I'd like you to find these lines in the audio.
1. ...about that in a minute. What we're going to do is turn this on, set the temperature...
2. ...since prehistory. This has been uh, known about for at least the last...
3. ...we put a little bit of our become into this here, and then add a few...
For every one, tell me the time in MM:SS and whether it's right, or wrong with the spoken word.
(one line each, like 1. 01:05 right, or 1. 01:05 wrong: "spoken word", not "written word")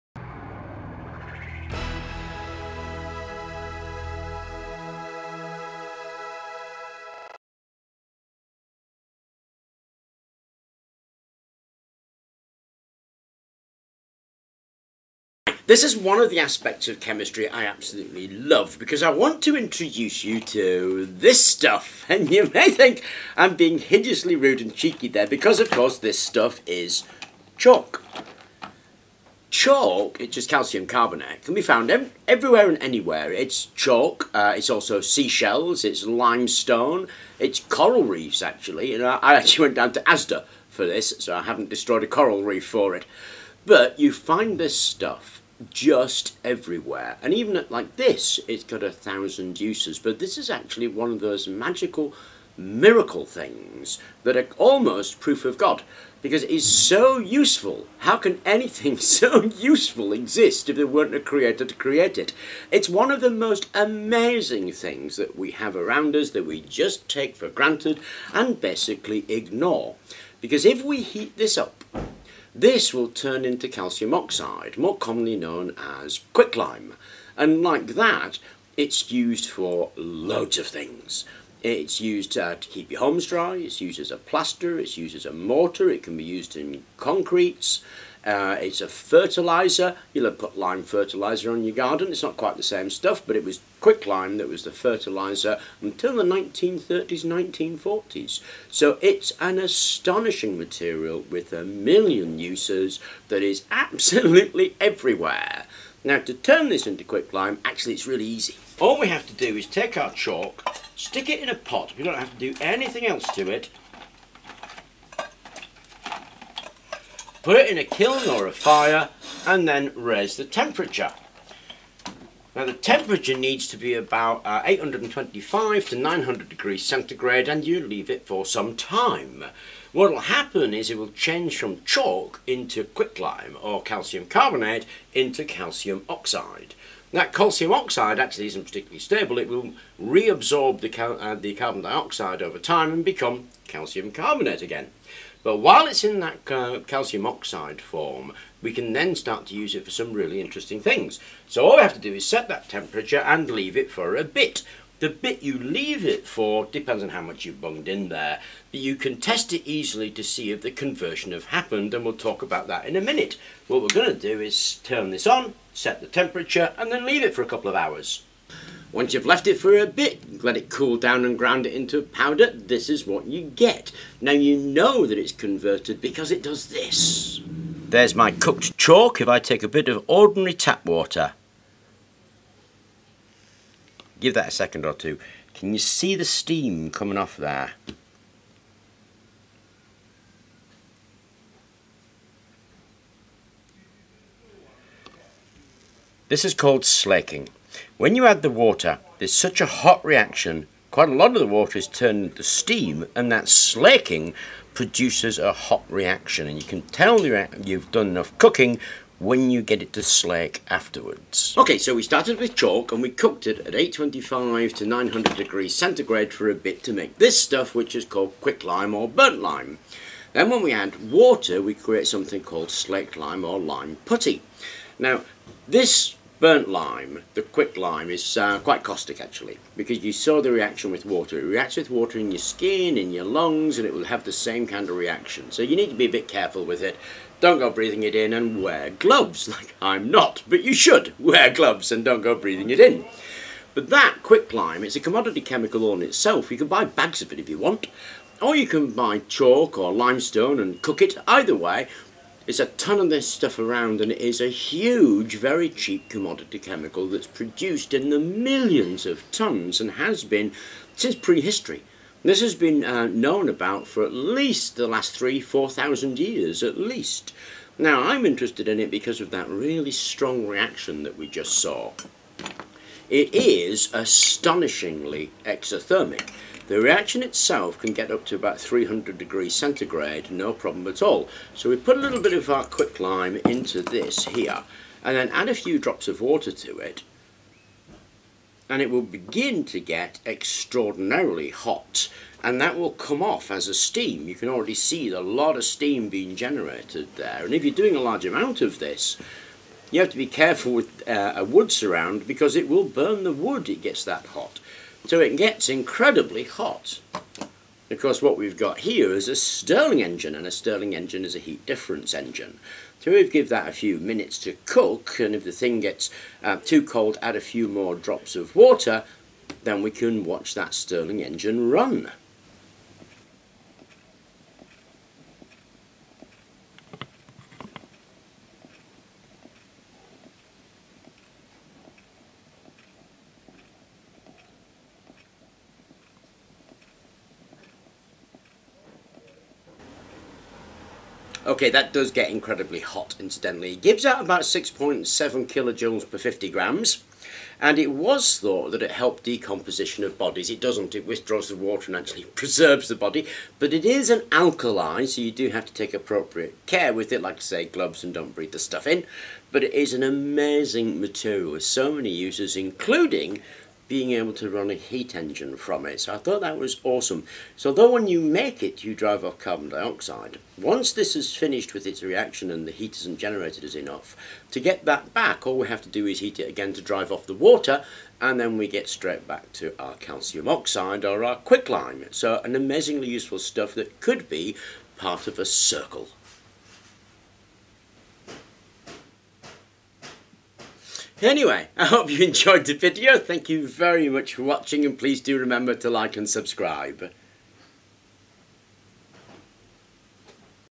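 1. 02:42 right
2. 04:20 right
3. 04:41 wrong: "quicklime", not "become".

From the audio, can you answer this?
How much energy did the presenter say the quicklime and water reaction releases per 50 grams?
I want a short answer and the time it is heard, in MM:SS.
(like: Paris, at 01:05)
6.7 kilojoules, at 05:44.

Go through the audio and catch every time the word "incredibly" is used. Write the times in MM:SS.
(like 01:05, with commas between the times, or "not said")
05:05, 05:42.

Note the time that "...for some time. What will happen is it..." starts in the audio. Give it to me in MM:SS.
02:08.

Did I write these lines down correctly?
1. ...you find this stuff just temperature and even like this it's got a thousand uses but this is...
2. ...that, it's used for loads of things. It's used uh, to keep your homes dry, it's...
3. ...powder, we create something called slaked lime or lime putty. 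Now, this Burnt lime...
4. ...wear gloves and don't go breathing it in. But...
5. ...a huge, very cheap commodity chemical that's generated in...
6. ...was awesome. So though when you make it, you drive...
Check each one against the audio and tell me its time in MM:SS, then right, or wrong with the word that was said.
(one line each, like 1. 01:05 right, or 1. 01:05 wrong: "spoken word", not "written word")
1. 00:43 wrong: "everywhere", not "temperature"
2. 01:17 right
3. 03:41 wrong: "water", not "powder"
4. 04:01 right
5. 04:14 wrong: "produced", not "generated"
6. 06:06 right.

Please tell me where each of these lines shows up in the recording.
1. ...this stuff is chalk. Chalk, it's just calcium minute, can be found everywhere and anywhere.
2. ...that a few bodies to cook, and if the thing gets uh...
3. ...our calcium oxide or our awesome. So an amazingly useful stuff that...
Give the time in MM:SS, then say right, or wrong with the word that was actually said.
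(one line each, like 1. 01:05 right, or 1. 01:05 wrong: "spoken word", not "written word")
1. 00:25 wrong: "carbonate", not "minute"
2. 05:13 wrong: "minutes", not "bodies"
3. 06:19 wrong: "quicklime", not "awesome".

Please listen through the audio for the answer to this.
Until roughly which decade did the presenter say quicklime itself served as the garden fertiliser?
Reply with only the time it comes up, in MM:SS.
01:37.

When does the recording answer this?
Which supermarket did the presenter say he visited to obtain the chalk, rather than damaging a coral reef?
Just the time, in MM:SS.
00:40.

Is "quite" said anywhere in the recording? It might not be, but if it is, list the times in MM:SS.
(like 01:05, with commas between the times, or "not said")
01:32, 03:20, 03:48.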